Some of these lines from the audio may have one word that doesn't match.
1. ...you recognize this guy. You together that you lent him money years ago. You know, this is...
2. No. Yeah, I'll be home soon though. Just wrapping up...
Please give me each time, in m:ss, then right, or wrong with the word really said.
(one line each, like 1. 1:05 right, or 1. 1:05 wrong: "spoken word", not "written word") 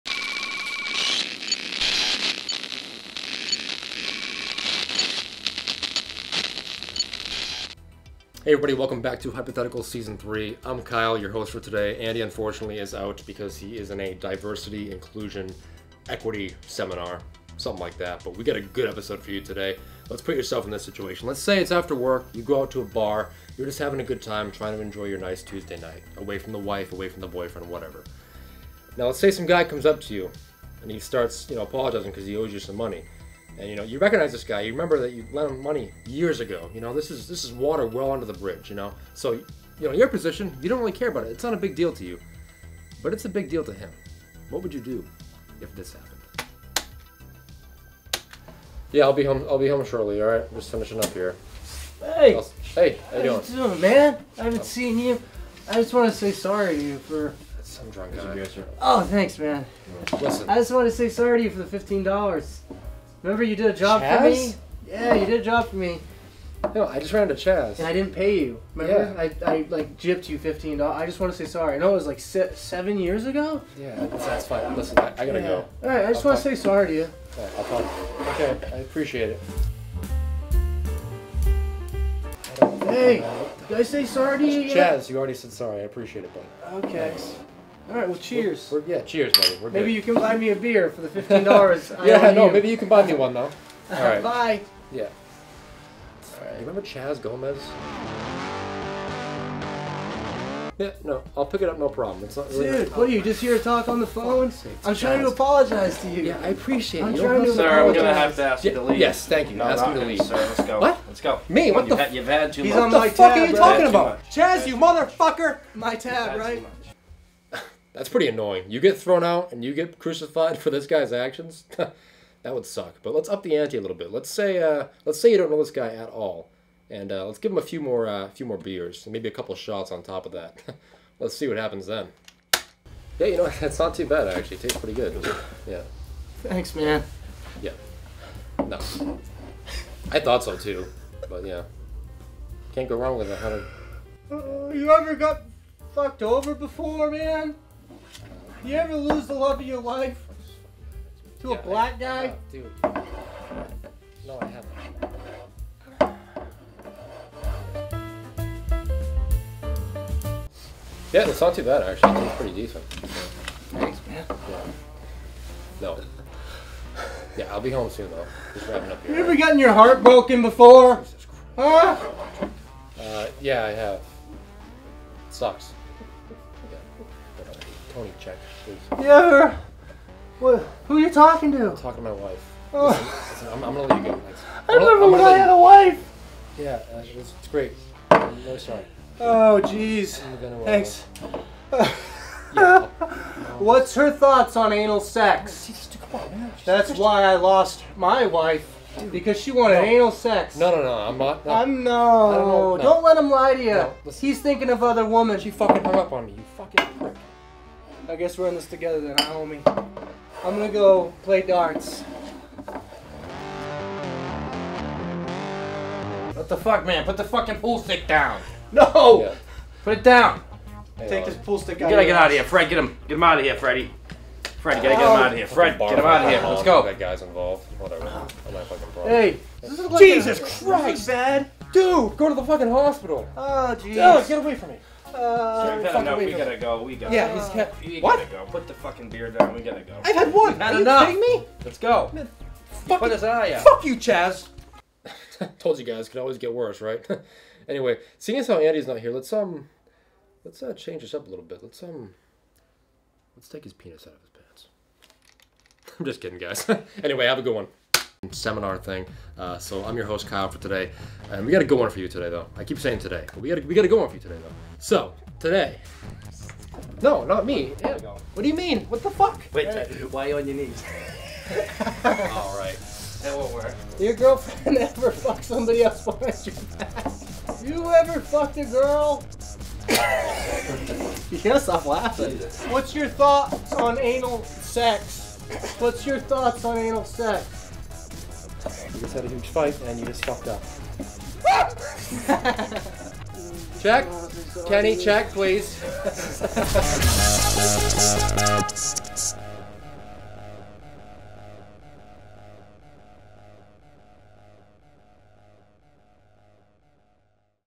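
1. 0:33 wrong: "remember", not "together"
2. 2:45 right.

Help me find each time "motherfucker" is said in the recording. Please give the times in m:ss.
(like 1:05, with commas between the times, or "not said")
1:54.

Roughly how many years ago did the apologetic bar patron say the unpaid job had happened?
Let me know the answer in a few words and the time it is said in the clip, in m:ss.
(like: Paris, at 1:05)
7, at 1:12.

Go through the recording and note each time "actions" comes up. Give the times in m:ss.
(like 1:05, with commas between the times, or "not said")
2:01.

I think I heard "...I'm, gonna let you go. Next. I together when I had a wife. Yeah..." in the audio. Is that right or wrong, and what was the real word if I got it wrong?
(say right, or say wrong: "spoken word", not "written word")
wrong: "remember", not "together".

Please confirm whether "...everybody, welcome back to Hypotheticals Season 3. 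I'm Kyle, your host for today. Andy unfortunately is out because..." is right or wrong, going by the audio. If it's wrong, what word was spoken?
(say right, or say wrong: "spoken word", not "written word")
right.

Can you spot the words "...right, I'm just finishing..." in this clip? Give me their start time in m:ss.
0:50.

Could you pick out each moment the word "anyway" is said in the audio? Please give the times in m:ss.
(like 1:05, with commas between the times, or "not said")
4:07, 4:17.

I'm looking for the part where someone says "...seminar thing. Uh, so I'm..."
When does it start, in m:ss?
4:18.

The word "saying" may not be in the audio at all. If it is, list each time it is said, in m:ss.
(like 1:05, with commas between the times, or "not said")
4:22.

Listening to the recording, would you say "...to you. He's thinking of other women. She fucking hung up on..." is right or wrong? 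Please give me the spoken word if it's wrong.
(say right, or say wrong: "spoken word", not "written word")
right.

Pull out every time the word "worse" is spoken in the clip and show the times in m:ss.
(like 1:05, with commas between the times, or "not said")
4:06.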